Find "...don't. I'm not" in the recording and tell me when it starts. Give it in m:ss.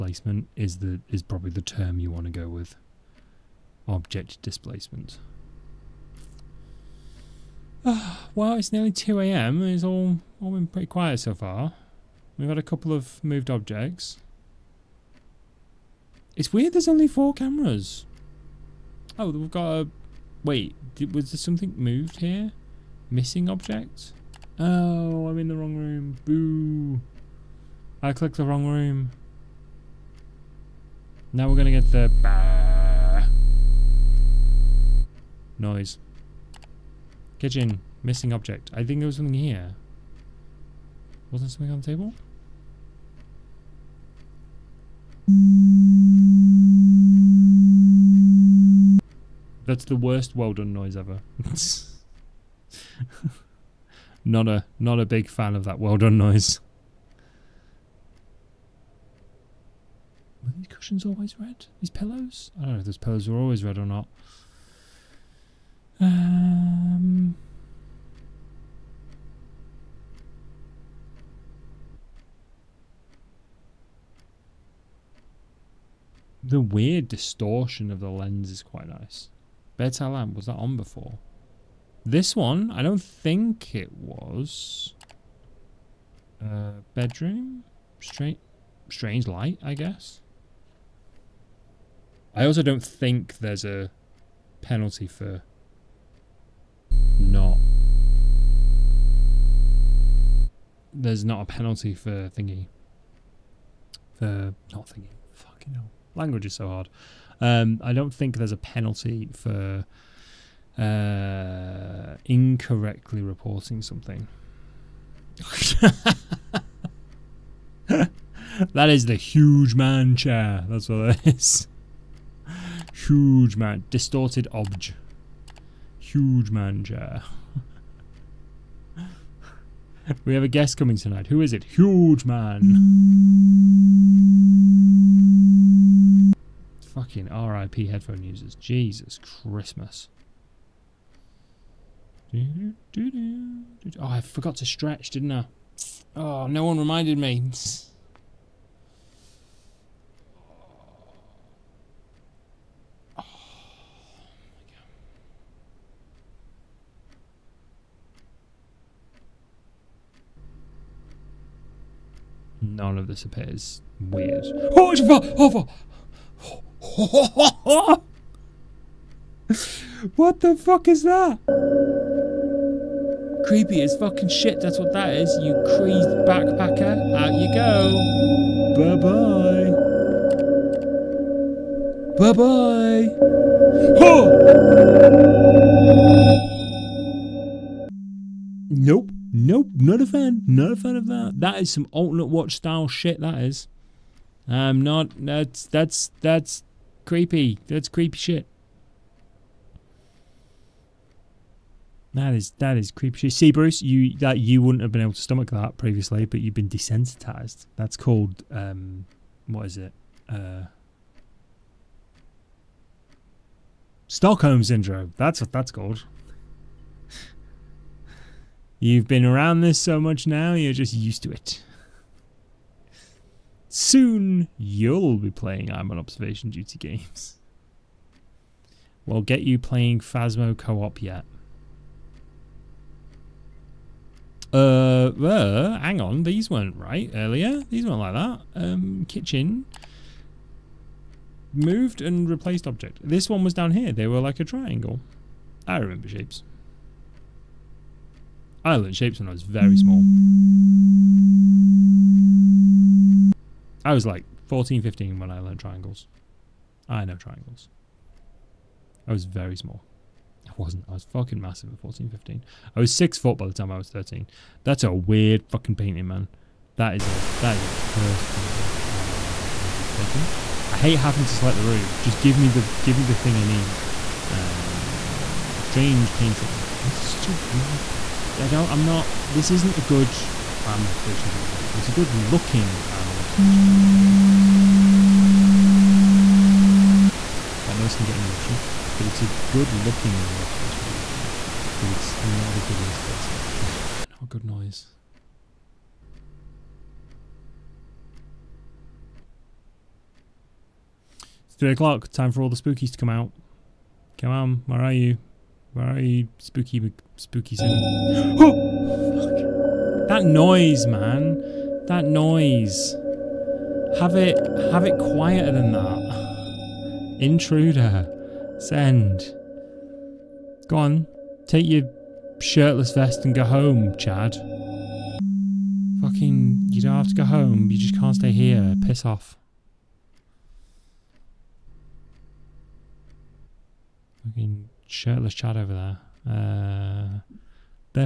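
4:38.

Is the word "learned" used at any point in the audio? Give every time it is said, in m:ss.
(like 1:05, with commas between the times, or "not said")
4:08, 4:15.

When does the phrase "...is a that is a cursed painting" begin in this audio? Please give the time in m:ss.
4:26.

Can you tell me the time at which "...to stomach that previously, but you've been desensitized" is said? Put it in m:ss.
3:25.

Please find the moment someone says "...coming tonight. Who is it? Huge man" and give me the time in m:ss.
2:10.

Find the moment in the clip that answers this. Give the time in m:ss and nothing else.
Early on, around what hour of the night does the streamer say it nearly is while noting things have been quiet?
0:08.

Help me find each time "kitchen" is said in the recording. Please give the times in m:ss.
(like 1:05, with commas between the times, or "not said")
0:37, 3:59.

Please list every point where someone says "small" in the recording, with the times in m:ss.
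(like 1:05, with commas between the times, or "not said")
4:09, 4:19.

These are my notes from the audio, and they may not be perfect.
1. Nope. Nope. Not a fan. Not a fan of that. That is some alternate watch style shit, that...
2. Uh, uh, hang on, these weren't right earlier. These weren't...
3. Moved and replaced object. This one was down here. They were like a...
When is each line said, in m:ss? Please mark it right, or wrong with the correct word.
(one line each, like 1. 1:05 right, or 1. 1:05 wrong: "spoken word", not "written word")
1. 3:08 right
2. 3:54 right
3. 4:01 right.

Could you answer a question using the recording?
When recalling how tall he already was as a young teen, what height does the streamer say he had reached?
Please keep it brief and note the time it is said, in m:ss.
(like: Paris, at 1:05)
6 foot, at 4:22.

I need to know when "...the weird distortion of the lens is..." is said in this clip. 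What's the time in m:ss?
1:16.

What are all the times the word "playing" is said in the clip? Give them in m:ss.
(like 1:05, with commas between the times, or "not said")
3:45, 3:49.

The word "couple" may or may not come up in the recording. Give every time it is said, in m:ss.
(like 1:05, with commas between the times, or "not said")
0:12.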